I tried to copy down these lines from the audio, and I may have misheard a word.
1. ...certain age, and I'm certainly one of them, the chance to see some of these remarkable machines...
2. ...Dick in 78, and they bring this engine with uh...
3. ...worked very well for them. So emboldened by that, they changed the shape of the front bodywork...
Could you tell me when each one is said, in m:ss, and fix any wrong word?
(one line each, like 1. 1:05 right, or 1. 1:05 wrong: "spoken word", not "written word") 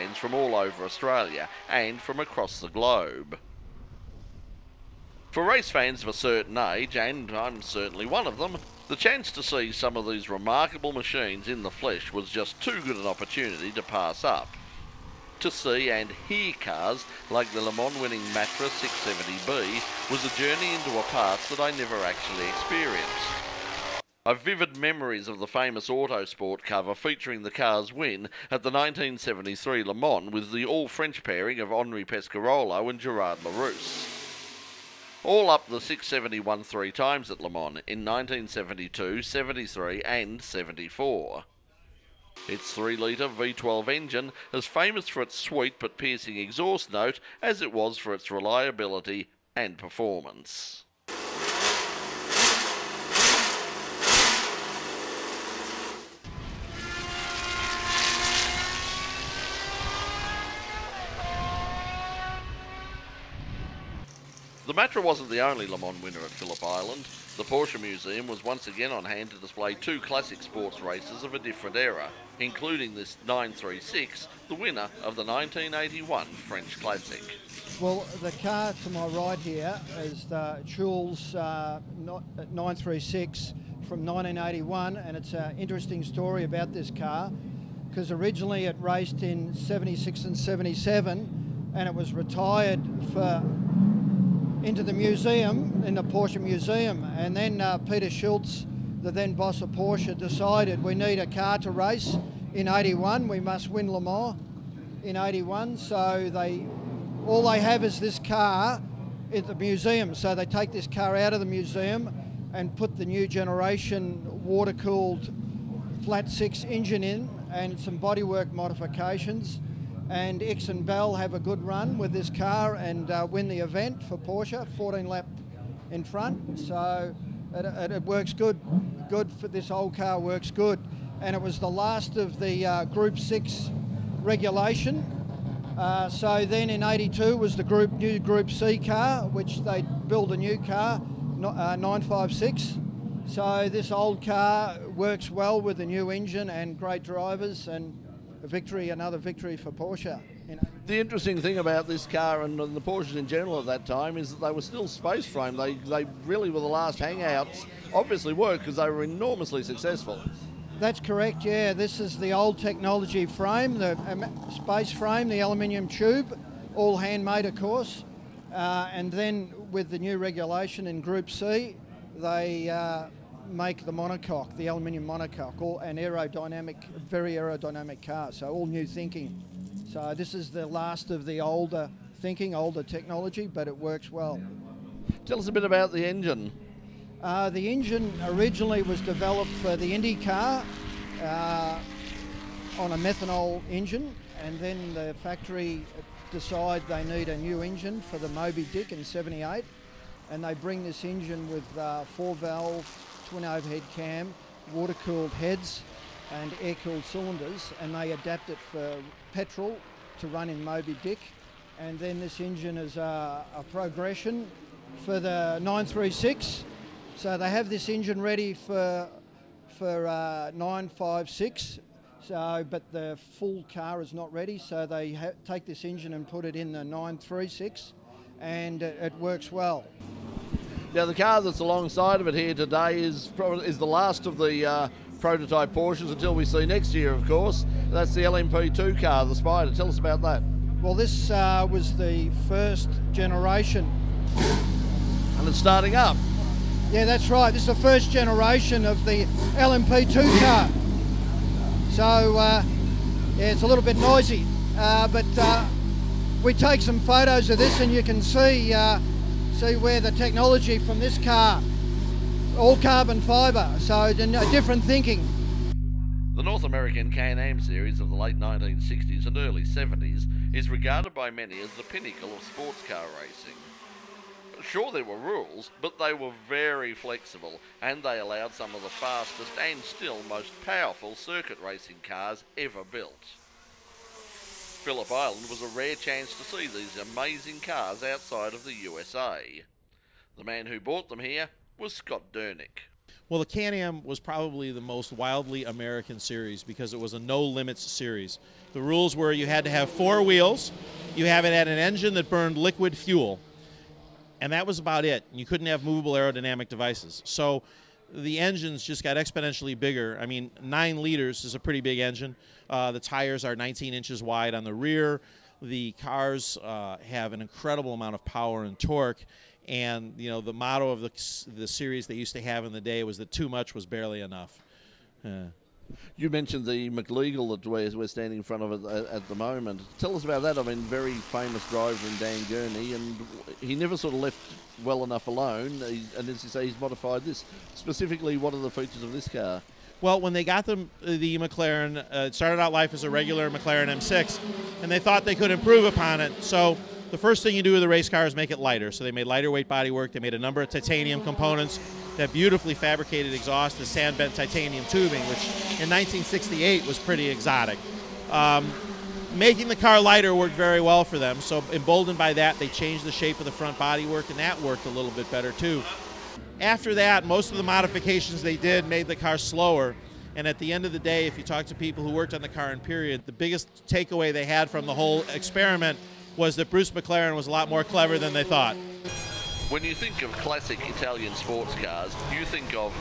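1. 0:06 right
2. 3:18 right
3. 6:00 right.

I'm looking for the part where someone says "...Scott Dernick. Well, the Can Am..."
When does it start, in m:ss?
4:51.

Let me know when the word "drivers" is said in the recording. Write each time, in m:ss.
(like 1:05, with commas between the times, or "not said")
2:27, 5:31.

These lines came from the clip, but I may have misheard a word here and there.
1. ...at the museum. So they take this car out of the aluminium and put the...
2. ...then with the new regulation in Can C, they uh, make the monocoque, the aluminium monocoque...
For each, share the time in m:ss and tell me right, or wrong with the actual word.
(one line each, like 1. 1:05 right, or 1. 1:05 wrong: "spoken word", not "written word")
1. 1:49 wrong: "museum", not "aluminium"
2. 2:49 wrong: "Group", not "Can".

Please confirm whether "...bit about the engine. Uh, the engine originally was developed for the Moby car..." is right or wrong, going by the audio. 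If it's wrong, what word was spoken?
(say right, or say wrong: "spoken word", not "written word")
wrong: "Indy", not "Moby".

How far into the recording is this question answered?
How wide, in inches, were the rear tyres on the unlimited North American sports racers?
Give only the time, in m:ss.
5:13.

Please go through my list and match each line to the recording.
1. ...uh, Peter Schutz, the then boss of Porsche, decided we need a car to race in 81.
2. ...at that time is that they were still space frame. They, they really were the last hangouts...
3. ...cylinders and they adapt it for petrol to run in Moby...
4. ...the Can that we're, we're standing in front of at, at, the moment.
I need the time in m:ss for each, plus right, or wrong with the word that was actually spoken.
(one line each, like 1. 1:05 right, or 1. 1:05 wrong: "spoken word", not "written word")
1. 1:37 right
2. 2:33 right
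3. 3:27 right
4. 5:26 wrong: "McLeagle", not "Can".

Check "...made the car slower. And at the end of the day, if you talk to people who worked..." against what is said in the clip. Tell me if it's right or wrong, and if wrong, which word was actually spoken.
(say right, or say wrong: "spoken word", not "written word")
right.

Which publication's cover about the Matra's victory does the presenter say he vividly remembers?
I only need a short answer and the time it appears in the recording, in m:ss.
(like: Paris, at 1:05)
Autosport, at 0:25.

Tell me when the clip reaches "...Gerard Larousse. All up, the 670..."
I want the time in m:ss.
0:32.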